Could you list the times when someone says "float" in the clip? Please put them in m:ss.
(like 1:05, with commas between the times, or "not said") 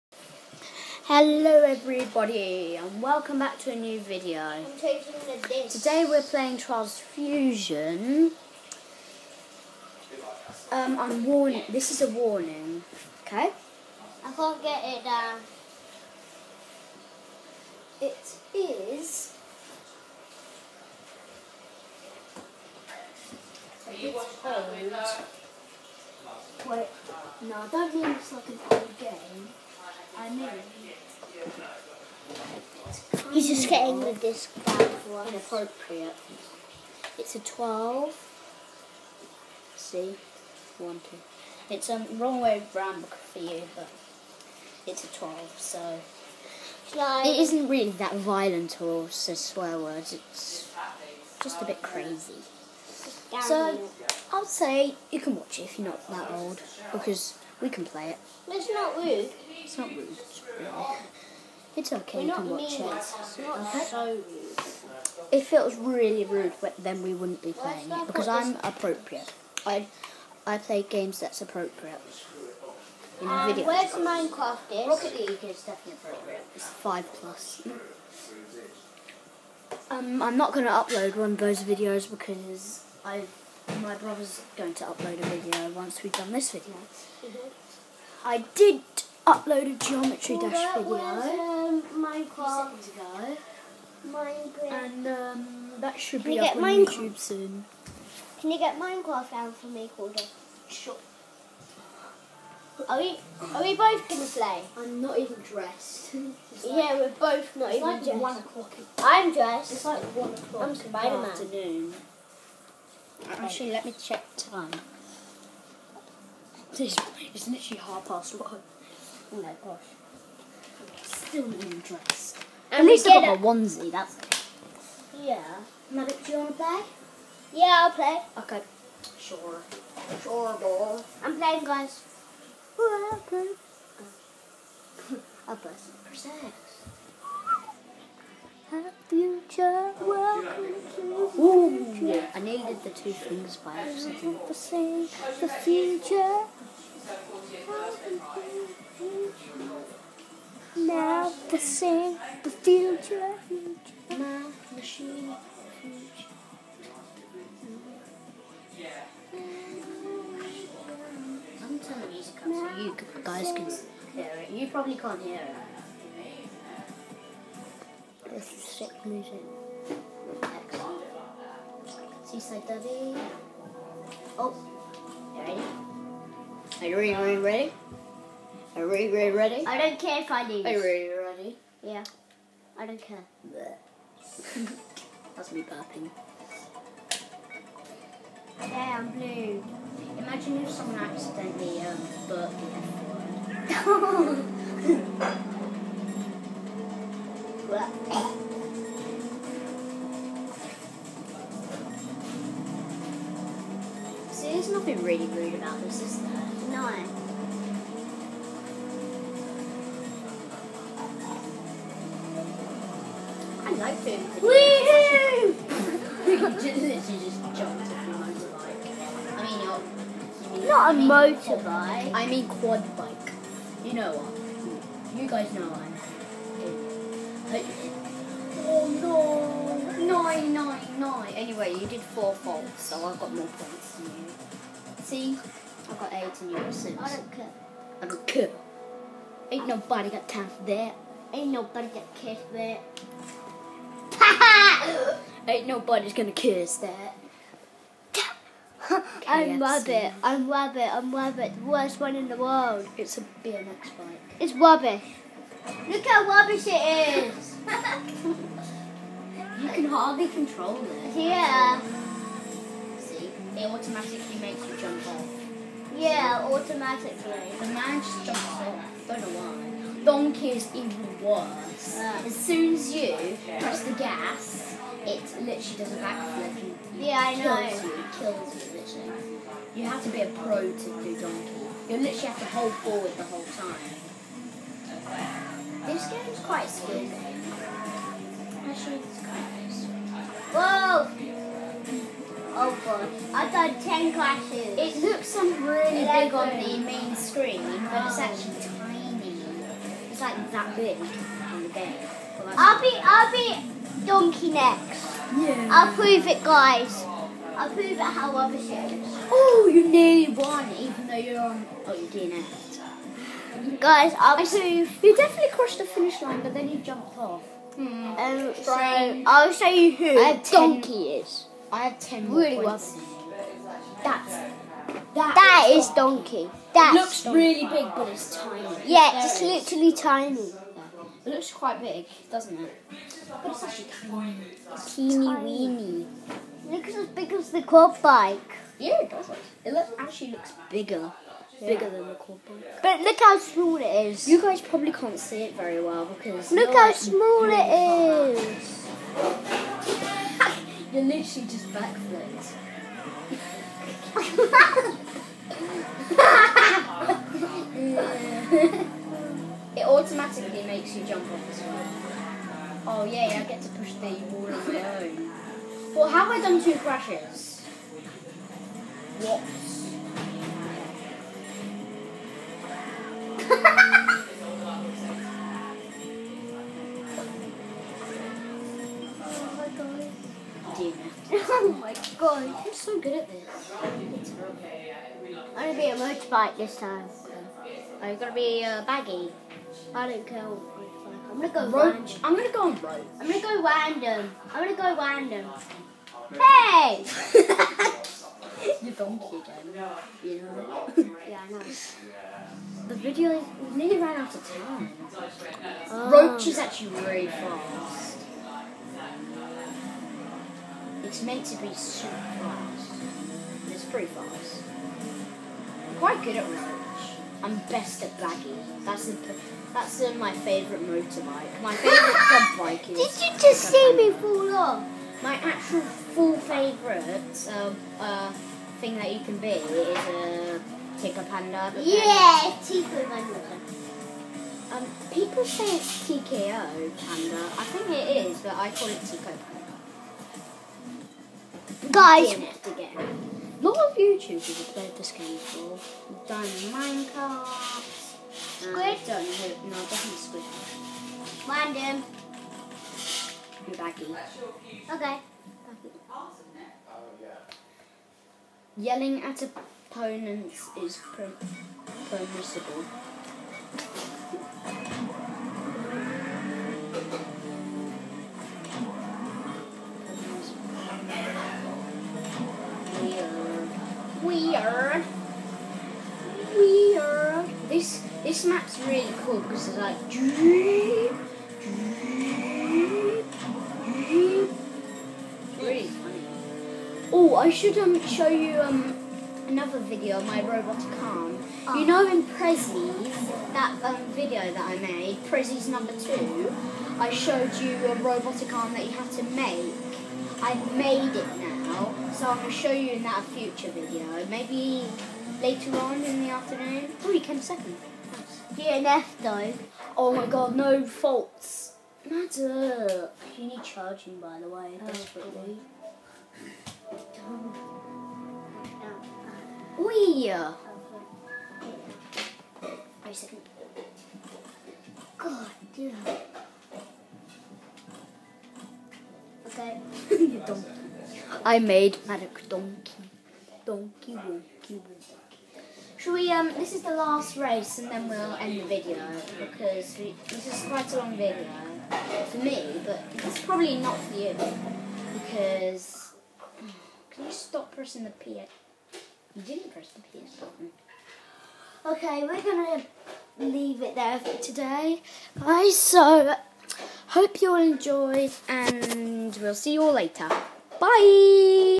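not said.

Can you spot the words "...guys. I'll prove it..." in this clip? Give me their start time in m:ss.
5:06.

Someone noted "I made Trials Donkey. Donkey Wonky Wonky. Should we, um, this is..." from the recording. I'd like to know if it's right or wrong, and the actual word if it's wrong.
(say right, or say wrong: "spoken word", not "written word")
wrong: "Manic", not "Trials".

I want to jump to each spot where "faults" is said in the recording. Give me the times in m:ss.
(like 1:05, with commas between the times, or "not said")
3:52, 8:30.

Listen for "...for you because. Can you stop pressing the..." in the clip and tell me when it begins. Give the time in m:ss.
9:03.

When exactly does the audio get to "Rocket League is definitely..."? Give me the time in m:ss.
1:14.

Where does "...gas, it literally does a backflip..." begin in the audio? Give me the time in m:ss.
4:33.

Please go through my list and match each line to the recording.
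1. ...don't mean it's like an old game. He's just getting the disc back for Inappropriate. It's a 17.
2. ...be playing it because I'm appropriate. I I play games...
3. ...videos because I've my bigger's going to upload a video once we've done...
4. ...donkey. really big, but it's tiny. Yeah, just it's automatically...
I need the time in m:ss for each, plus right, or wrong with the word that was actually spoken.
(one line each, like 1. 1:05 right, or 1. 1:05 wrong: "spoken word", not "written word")
1. 0:27 wrong: "12", not "17"
2. 1:07 right
3. 1:21 wrong: "brother", not "bigger"
4. 5:27 wrong: "literally", not "automatically".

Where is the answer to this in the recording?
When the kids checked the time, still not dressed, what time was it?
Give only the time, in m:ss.
1:57.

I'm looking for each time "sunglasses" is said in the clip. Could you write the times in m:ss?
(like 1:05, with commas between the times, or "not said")
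not said.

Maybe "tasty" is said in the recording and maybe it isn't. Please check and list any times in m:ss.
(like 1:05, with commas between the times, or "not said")
not said.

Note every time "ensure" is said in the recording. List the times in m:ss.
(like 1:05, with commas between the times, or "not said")
not said.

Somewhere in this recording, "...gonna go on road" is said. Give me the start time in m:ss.
6:32.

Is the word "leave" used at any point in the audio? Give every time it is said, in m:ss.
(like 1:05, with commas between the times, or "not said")
9:13.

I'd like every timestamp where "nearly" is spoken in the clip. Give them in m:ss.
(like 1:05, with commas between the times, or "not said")
5:09, 6:43.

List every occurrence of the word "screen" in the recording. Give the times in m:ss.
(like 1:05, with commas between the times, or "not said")
4:57.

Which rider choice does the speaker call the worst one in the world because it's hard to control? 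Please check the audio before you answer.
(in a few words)
BMX bike.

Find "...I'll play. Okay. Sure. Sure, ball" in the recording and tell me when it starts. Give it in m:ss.
2:07.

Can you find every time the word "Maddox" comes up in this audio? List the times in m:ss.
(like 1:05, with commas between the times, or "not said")
2:05.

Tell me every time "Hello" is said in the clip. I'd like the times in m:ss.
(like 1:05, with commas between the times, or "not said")
0:01.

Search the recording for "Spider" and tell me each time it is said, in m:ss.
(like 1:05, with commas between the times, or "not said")
1:50.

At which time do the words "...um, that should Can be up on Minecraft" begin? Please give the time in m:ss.
1:35.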